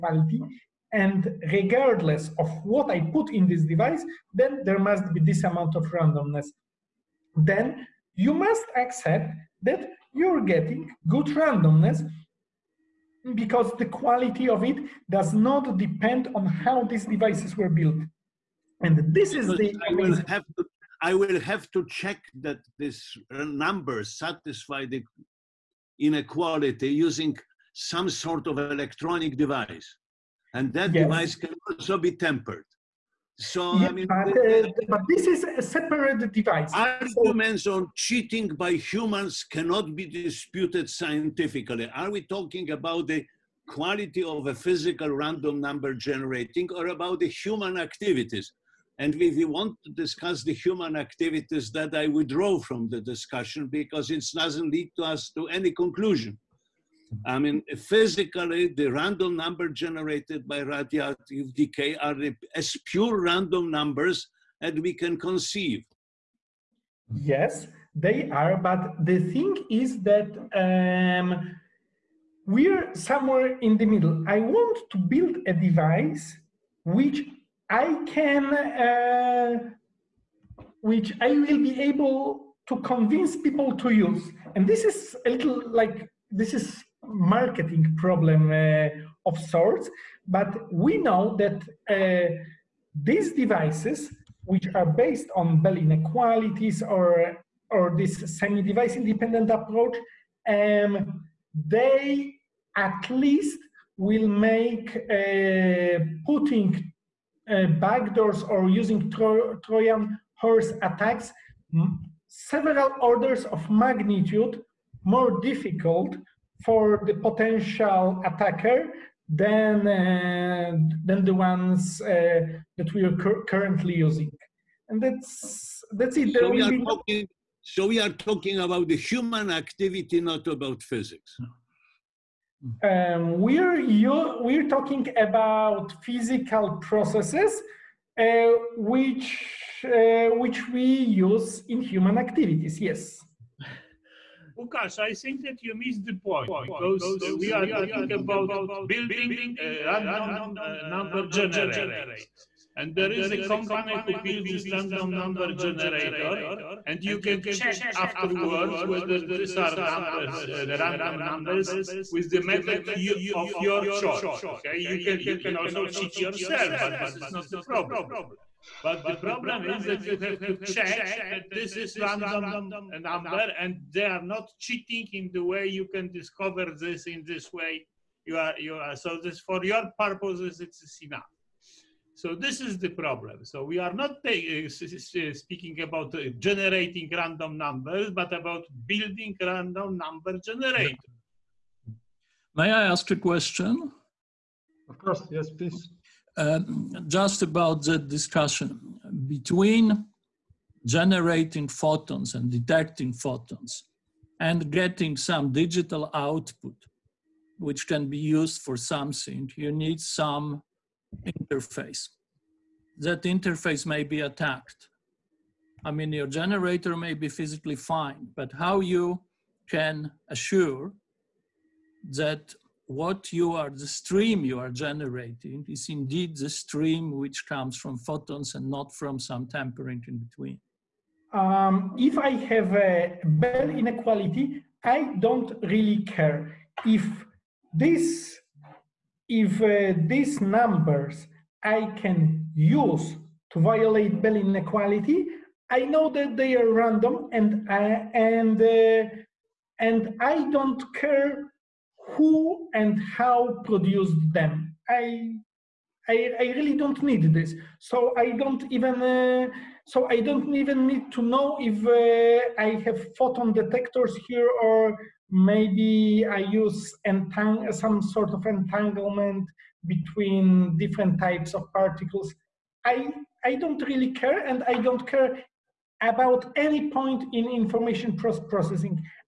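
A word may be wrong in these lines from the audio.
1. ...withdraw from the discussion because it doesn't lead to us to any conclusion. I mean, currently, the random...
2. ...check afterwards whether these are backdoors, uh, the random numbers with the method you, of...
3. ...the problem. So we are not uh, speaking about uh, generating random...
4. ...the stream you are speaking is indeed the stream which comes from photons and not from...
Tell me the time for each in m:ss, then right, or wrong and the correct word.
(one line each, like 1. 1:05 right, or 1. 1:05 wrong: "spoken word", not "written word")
1. 0:52 wrong: "physically", not "currently"
2. 2:37 wrong: "numbers", not "backdoors"
3. 3:02 right
4. 3:43 wrong: "generating", not "speaking".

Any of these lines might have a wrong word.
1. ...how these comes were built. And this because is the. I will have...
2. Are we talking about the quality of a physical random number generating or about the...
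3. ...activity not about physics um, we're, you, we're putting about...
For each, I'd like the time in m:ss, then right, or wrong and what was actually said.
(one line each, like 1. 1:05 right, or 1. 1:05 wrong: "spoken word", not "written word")
1. 0:16 wrong: "devices", not "comes"
2. 0:41 right
3. 2:09 wrong: "talking", not "putting".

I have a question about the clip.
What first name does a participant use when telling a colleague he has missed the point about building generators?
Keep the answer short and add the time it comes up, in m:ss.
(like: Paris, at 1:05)
Łukasz, at 2:24.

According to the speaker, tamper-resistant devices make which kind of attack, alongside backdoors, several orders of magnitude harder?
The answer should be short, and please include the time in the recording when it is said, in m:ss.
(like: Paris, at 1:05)
Trojan horse attacks, at 1:49.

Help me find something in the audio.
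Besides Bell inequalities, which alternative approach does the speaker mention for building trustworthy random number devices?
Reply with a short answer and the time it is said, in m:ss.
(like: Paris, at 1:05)
semi-device independent, at 1:38.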